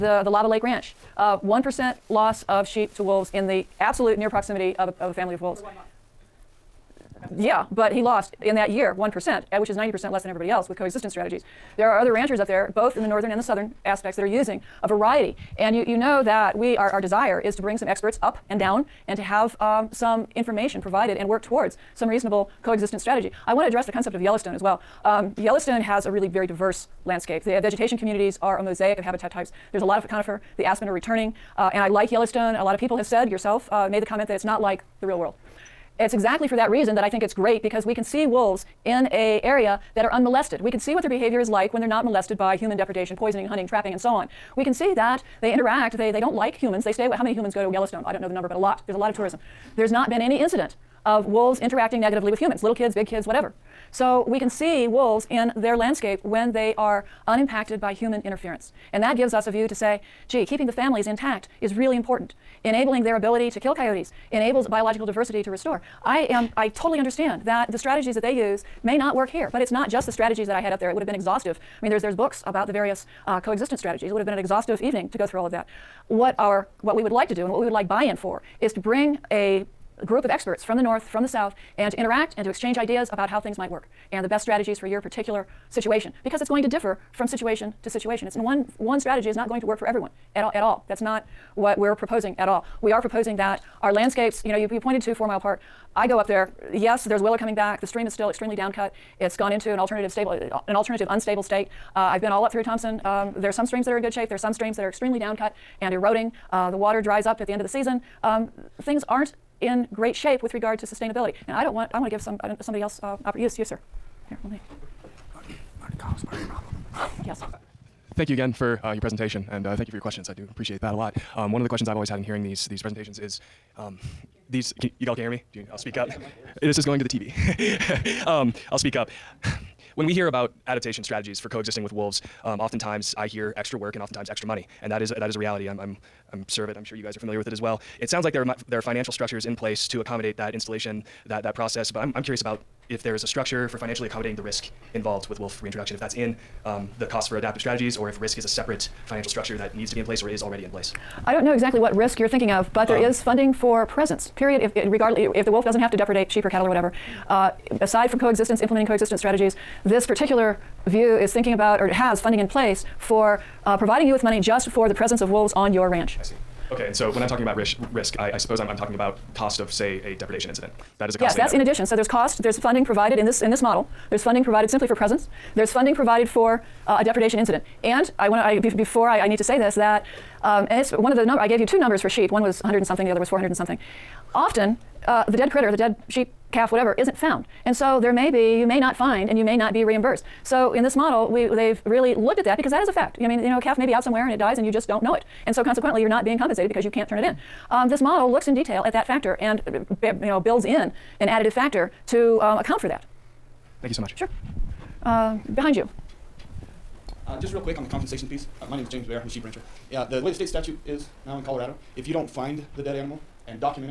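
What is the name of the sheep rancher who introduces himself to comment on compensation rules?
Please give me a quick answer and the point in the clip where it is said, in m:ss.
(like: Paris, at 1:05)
James Bear, at 3:28.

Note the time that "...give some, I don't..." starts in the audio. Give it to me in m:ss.
1:52.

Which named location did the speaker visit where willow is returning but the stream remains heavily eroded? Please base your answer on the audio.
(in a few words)
Four Mile Park.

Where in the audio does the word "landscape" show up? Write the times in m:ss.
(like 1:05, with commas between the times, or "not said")
0:27, 0:55, 1:33.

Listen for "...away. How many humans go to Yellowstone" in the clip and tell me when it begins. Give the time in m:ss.
0:47.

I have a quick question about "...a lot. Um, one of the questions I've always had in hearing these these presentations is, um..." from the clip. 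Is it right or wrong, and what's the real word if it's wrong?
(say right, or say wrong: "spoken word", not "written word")
right.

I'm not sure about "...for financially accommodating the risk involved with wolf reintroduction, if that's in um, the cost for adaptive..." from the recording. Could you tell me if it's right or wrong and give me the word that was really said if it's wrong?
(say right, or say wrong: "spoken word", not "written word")
right.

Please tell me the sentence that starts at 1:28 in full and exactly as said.
It's one, one strategy is not going to work for everyone at all, at all.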